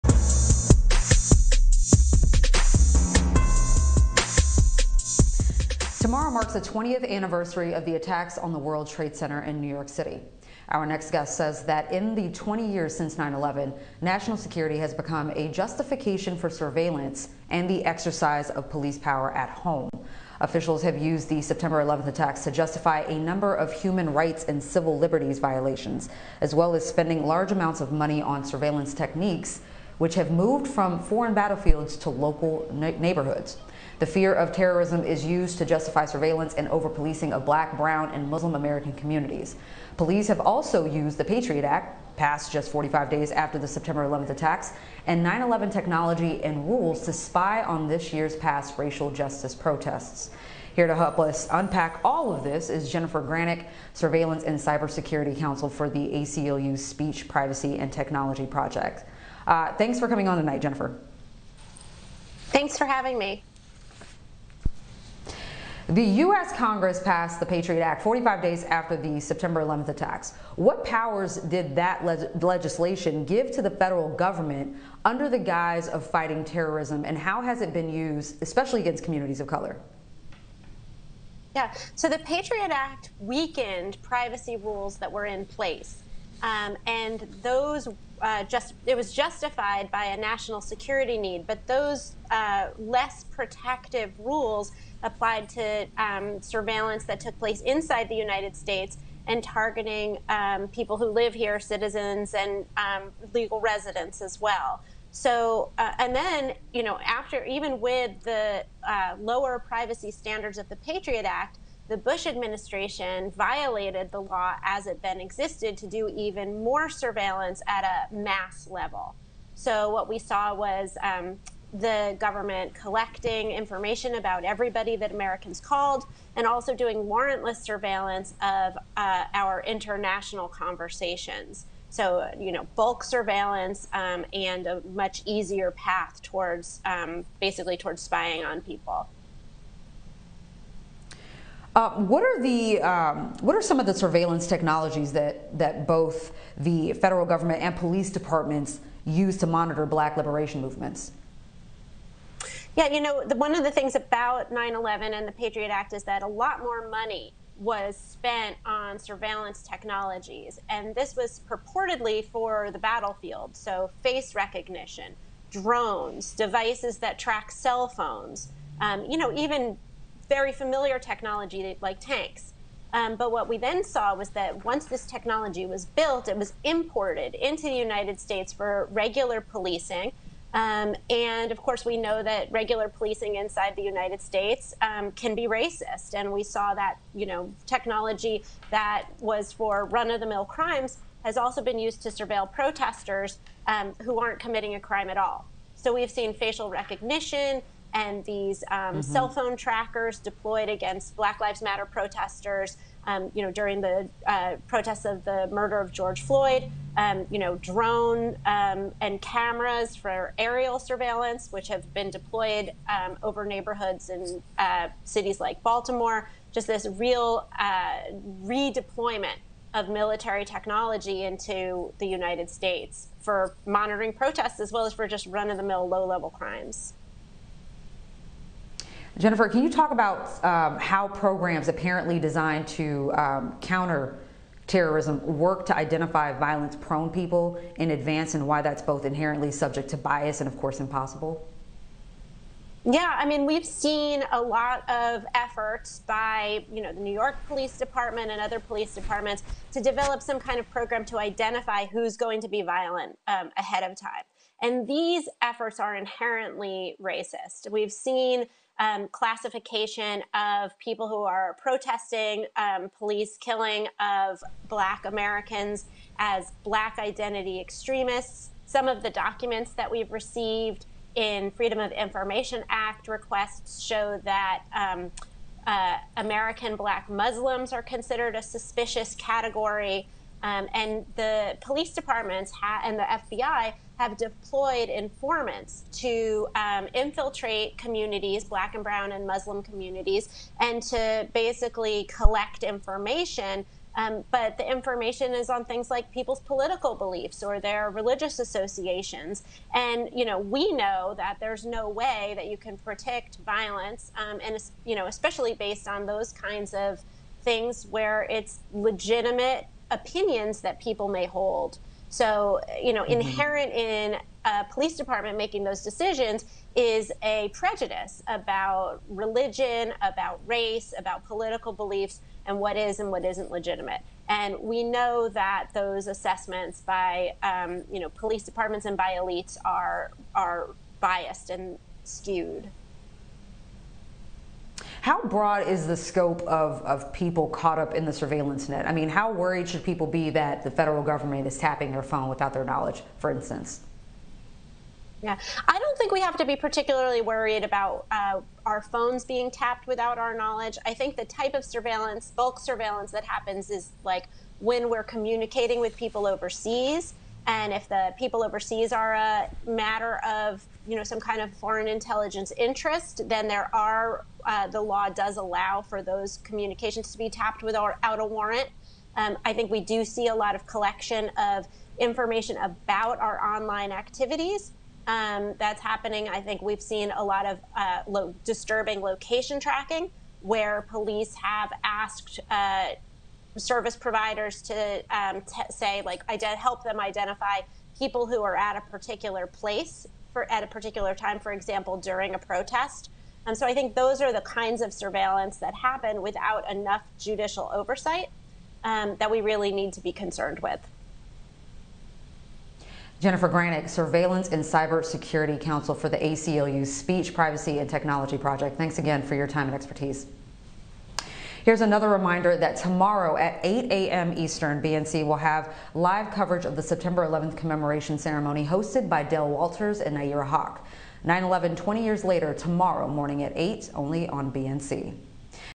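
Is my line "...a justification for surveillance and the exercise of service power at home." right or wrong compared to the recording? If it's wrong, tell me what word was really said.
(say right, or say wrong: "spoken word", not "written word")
wrong: "police", not "service".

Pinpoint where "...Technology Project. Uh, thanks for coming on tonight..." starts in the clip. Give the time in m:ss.
0:57.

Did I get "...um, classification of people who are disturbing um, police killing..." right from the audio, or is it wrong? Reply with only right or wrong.
wrong.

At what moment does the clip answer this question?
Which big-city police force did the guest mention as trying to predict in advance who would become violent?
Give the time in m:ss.
4:07.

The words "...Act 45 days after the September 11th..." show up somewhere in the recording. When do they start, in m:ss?
1:07.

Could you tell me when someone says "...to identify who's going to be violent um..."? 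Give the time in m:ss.
4:11.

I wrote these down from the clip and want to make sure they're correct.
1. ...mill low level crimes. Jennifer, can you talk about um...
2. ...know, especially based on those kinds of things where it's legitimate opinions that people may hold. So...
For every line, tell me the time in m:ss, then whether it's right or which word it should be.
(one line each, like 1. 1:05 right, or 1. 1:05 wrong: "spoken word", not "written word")
1. 3:45 right
2. 5:04 right.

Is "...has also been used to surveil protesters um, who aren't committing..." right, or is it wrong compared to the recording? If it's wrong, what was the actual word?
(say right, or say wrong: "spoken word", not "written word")
right.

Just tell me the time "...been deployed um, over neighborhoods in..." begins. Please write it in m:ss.
3:31.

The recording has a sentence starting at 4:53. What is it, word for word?
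Um, but the information is on things like people's political beliefs or their religious associations.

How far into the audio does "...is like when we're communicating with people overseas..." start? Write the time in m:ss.
5:53.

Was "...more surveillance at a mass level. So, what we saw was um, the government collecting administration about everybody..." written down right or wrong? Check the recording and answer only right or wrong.
wrong.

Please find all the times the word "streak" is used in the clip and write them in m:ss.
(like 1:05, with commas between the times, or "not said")
not said.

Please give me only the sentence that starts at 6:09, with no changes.
Um, I think we do see a lot of collection of information about our online activities.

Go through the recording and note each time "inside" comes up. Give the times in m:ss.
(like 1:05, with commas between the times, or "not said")
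1:37, 3:03.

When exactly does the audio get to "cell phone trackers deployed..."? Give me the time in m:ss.
3:19.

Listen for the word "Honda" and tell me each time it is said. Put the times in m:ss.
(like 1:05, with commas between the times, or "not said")
not said.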